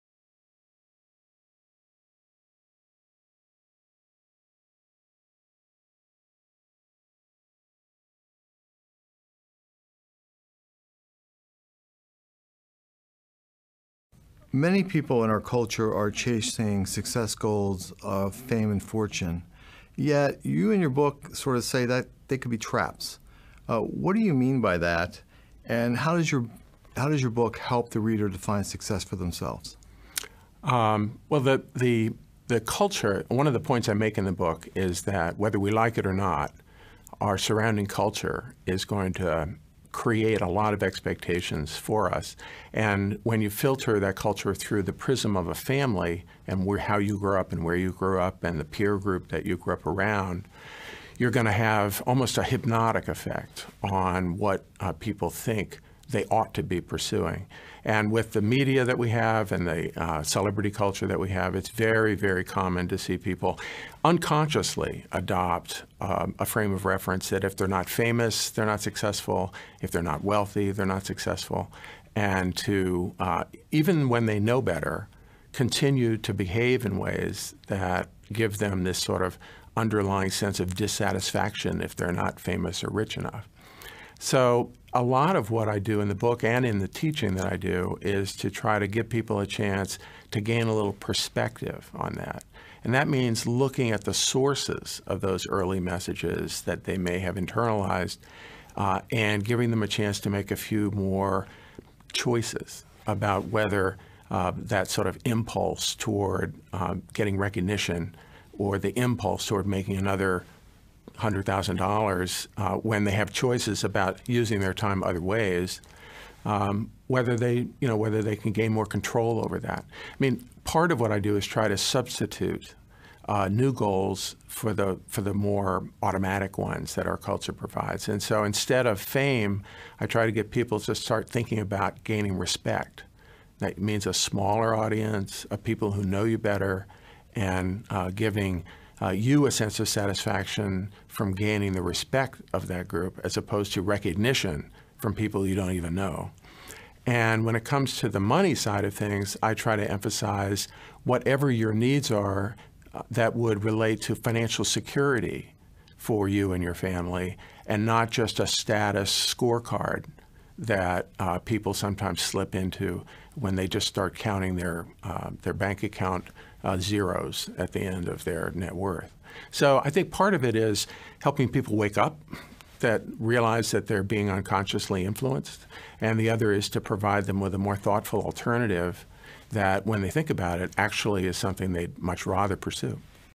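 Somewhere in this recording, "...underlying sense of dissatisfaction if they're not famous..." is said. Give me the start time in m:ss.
1:19.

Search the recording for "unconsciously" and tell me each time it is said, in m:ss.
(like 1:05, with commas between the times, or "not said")
1:04, 2:54.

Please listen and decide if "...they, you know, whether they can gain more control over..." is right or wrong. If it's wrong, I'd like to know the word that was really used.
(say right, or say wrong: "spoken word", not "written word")
right.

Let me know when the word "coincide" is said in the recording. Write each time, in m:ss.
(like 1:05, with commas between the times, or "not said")
not said.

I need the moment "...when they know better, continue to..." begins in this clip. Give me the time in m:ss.
1:14.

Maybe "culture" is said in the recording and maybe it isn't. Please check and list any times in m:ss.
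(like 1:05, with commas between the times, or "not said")
0:15, 0:32, 0:37, 0:44, 1:00, 2:07.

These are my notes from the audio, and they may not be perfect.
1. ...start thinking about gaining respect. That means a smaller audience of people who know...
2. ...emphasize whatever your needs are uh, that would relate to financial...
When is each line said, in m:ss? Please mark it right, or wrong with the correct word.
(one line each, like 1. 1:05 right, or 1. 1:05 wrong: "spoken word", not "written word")
1. 2:10 right
2. 2:29 right.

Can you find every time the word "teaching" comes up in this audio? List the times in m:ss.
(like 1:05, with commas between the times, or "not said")
1:26.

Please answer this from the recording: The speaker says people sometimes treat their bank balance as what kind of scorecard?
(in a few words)
Status scorecard.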